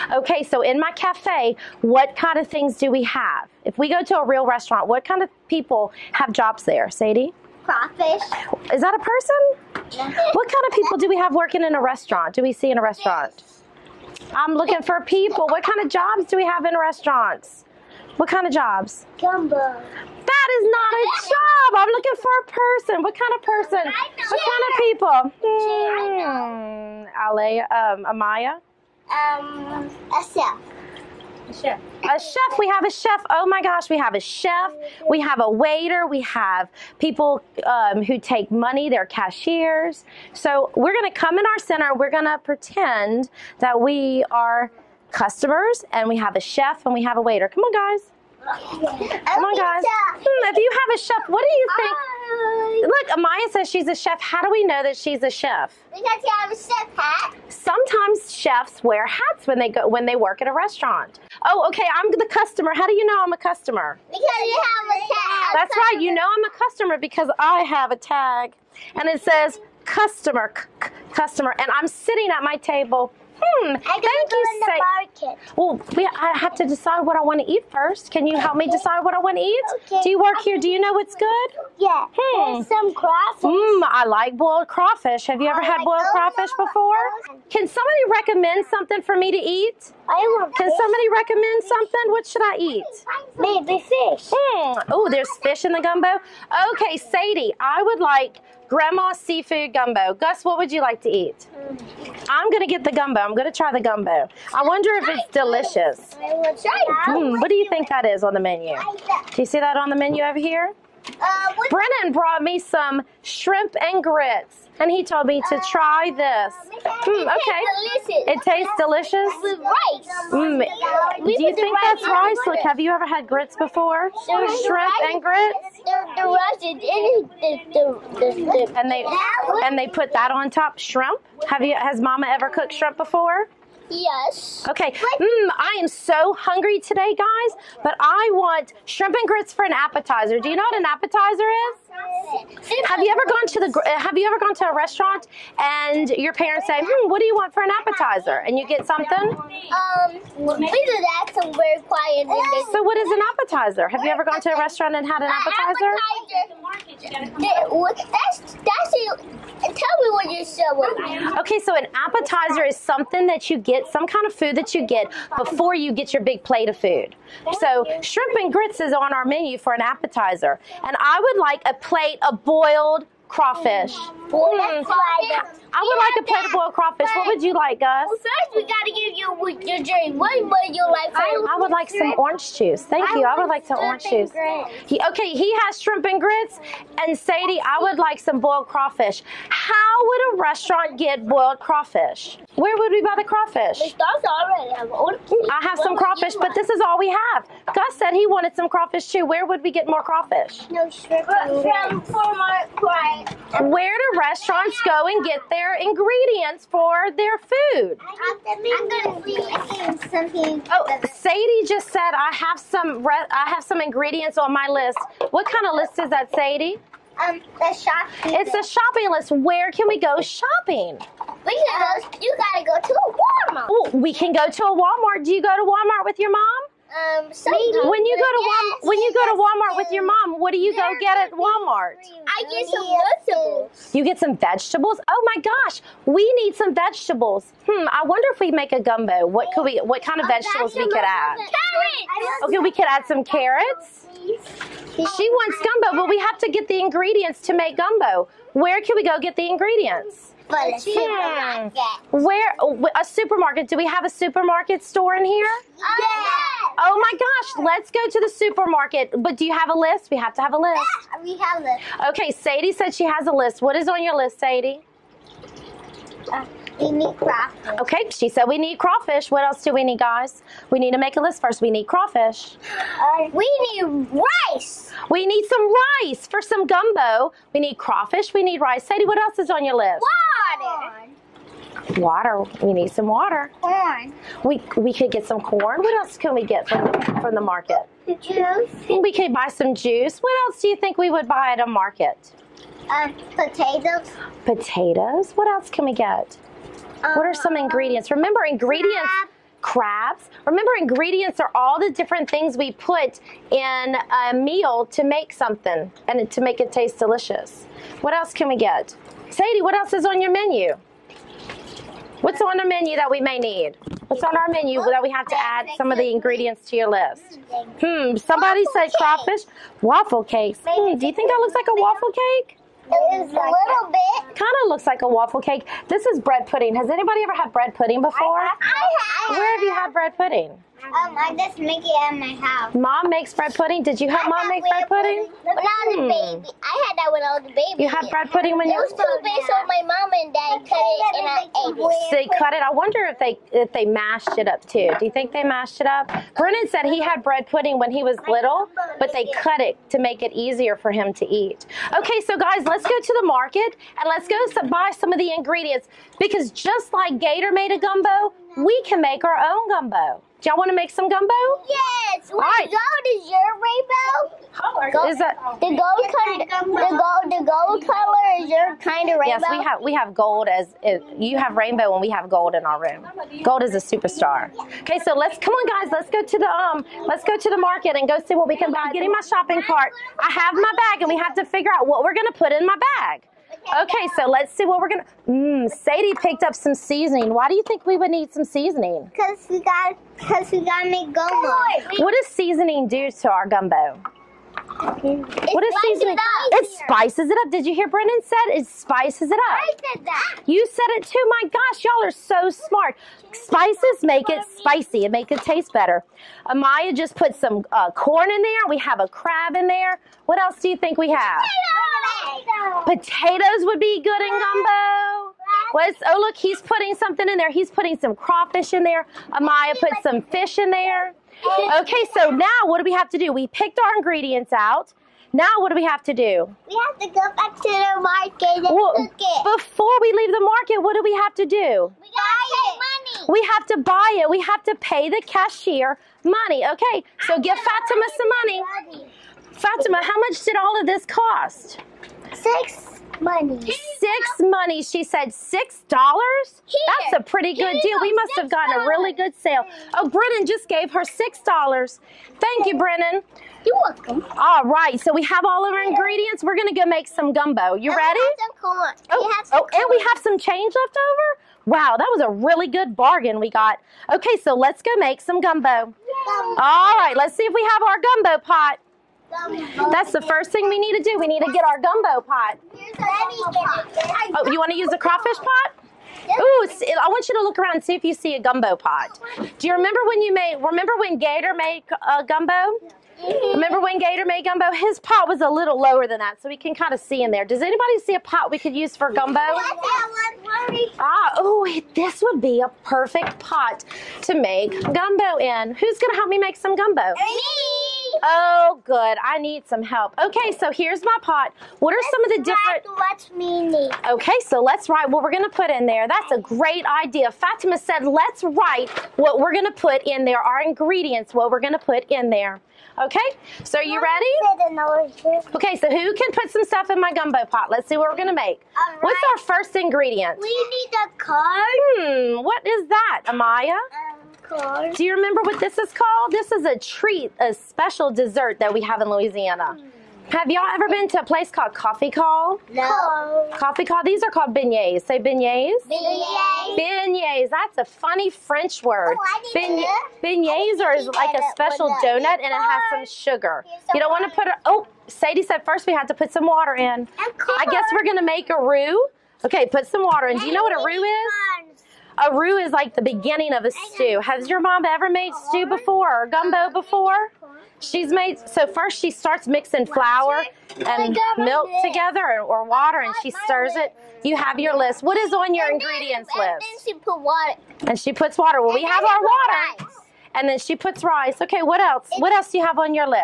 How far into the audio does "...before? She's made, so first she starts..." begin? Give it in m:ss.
9:16.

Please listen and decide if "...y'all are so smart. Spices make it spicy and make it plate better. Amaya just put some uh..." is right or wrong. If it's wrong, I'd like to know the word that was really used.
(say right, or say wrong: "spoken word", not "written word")
wrong: "taste", not "plate".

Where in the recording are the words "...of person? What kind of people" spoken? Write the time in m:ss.
0:23.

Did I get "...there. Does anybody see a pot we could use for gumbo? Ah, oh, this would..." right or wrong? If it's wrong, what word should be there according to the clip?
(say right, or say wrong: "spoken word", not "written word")
right.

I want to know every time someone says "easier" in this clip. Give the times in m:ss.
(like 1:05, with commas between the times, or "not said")
5:50.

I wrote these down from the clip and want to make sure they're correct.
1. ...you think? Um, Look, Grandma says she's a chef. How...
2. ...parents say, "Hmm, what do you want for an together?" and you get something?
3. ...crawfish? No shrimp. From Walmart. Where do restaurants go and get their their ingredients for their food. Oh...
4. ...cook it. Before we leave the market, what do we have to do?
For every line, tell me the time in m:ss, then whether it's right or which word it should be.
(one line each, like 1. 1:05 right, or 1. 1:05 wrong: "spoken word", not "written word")
1. 0:51 wrong: "Amaya", not "Grandma"
2. 2:26 wrong: "appetizer", not "together"
3. 3:20 right
4. 7:08 right.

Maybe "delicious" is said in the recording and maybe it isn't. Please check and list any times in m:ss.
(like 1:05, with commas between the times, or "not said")
1:45, 1:58, 5:06.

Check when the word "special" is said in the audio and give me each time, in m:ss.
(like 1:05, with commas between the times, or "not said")
8:47, 9:01.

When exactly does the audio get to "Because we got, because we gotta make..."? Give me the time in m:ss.
6:29.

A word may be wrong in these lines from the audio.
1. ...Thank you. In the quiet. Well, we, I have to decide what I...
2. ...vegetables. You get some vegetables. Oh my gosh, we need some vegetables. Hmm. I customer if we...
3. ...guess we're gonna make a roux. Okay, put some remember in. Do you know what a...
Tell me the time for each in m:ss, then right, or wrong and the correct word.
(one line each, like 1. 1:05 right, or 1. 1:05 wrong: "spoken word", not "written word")
1. 1:13 wrong: "market", not "quiet"
2. 3:53 wrong: "wonder", not "customer"
3. 9:07 wrong: "water", not "remember".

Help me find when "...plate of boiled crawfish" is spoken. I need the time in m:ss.
2:51.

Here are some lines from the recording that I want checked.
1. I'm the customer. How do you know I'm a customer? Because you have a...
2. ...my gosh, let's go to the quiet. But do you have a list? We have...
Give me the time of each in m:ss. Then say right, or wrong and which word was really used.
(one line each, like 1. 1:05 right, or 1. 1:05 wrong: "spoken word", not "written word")
1. 1:01 right
2. 4:16 wrong: "supermarket", not "quiet".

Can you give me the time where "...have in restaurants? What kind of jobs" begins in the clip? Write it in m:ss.
0:16.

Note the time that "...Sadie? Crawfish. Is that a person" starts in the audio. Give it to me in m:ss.
0:06.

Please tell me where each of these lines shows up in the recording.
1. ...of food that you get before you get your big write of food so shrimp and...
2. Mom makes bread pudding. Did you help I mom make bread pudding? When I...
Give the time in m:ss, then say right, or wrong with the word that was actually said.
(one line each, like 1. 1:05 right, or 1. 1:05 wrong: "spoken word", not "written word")
1. 2:44 wrong: "plate", not "write"
2. 5:32 right.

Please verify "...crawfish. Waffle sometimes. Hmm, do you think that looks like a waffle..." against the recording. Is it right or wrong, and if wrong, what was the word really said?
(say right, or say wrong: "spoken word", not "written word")
wrong: "cakes", not "sometimes".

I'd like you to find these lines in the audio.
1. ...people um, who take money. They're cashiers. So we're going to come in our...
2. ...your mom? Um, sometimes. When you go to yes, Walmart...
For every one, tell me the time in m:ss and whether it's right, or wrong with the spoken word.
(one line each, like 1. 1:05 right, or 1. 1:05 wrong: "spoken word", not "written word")
1. 0:36 right
2. 3:46 right.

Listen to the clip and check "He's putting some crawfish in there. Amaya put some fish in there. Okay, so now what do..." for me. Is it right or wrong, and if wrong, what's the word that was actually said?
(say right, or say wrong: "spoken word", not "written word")
right.